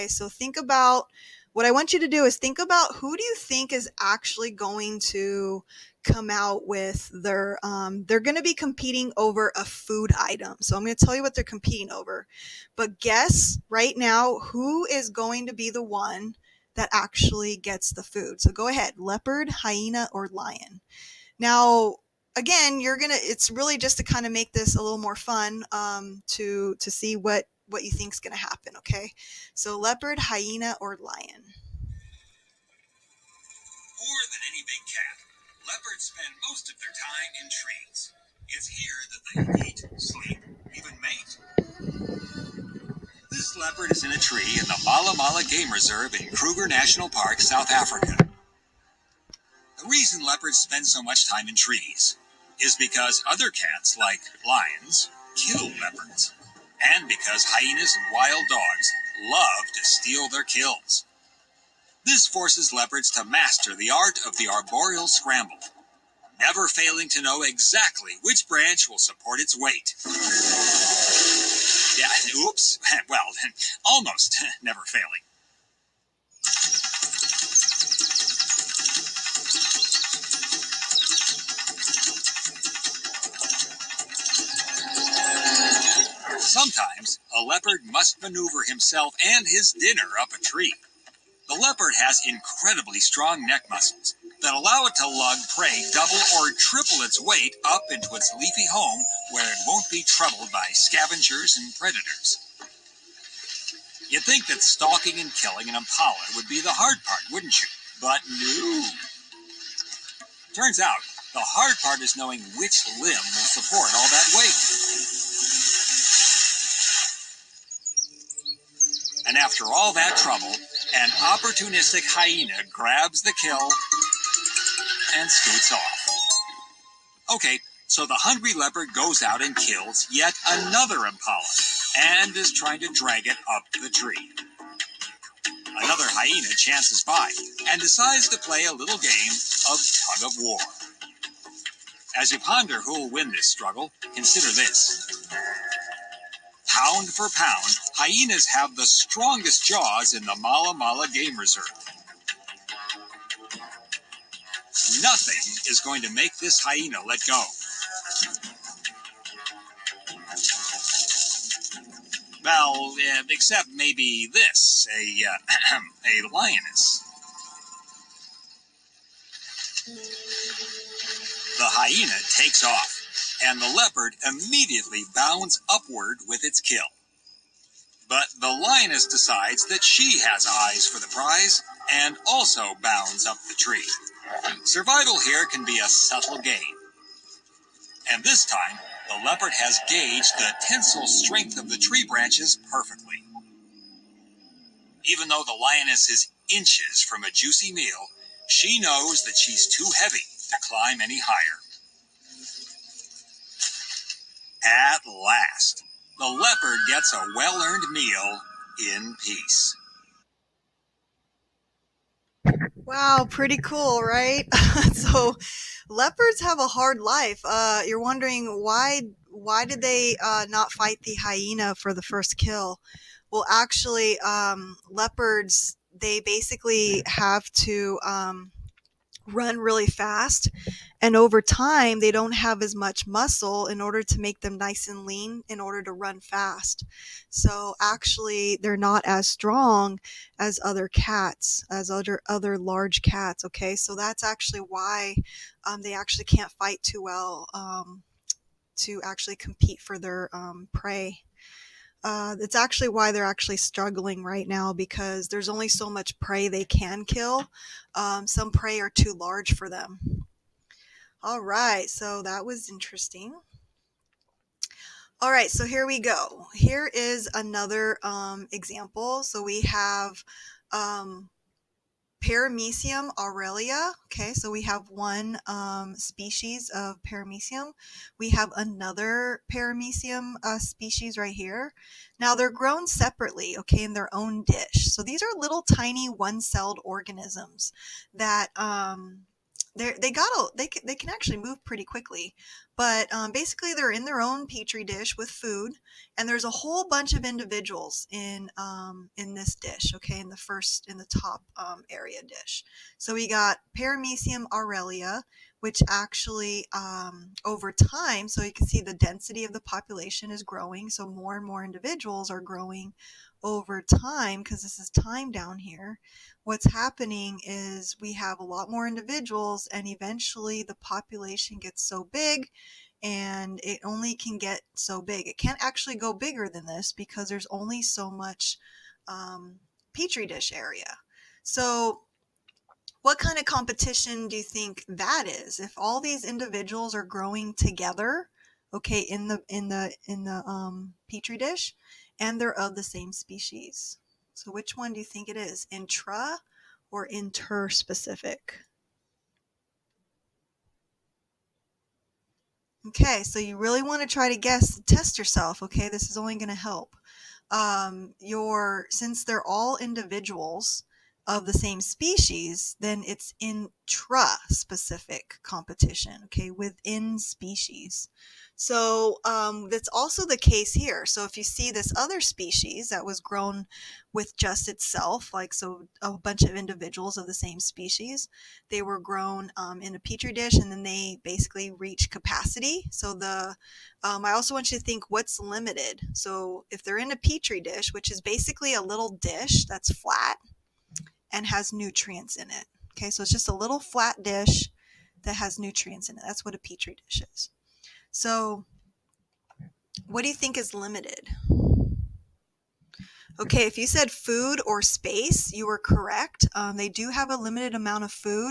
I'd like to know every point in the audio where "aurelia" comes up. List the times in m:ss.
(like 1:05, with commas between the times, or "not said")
4:33, 5:04.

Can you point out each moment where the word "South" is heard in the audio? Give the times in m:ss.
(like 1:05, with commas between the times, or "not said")
0:47.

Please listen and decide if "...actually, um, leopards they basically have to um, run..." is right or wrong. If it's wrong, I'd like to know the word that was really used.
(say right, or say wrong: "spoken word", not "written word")
right.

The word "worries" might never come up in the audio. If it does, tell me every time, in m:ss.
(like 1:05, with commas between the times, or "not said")
not said.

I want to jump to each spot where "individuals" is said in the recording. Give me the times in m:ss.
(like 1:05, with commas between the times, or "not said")
4:57, 5:11, 5:18, 5:36, 5:59, 6:16.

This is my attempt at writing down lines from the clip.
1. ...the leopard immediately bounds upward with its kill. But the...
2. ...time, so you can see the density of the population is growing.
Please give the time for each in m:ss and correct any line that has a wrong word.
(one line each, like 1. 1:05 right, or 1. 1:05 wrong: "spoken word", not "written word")
1. 2:53 right
2. 5:07 right.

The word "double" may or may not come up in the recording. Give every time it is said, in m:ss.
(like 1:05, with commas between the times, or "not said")
1:35.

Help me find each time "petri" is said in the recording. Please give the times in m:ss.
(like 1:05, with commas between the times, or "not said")
4:54, 5:29, 5:41, 6:19, 6:27, 6:36.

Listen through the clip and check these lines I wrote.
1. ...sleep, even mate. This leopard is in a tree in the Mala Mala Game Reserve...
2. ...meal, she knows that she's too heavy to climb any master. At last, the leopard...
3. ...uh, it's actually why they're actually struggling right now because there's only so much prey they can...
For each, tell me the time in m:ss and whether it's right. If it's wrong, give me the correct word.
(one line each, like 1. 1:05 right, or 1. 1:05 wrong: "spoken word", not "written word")
1. 0:39 right
2. 3:17 wrong: "higher", not "master"
3. 4:12 right.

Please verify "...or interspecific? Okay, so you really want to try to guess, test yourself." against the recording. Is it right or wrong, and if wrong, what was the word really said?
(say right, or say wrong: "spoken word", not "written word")
right.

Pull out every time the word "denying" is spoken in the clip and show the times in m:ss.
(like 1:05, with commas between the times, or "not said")
not said.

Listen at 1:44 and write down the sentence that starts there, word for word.
You'd think that stalking and killing an impala would be the hard part, wouldn't you?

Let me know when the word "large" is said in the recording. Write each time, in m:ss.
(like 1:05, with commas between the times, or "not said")
4:02, 4:19.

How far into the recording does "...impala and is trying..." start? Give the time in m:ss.
2:11.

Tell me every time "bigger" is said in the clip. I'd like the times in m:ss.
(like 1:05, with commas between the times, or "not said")
5:26.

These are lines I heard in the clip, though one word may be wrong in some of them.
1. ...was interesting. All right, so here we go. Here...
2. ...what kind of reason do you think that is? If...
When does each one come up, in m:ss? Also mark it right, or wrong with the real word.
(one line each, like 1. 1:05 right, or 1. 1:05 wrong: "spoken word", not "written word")
1. 4:22 right
2. 5:33 wrong: "competition", not "reason".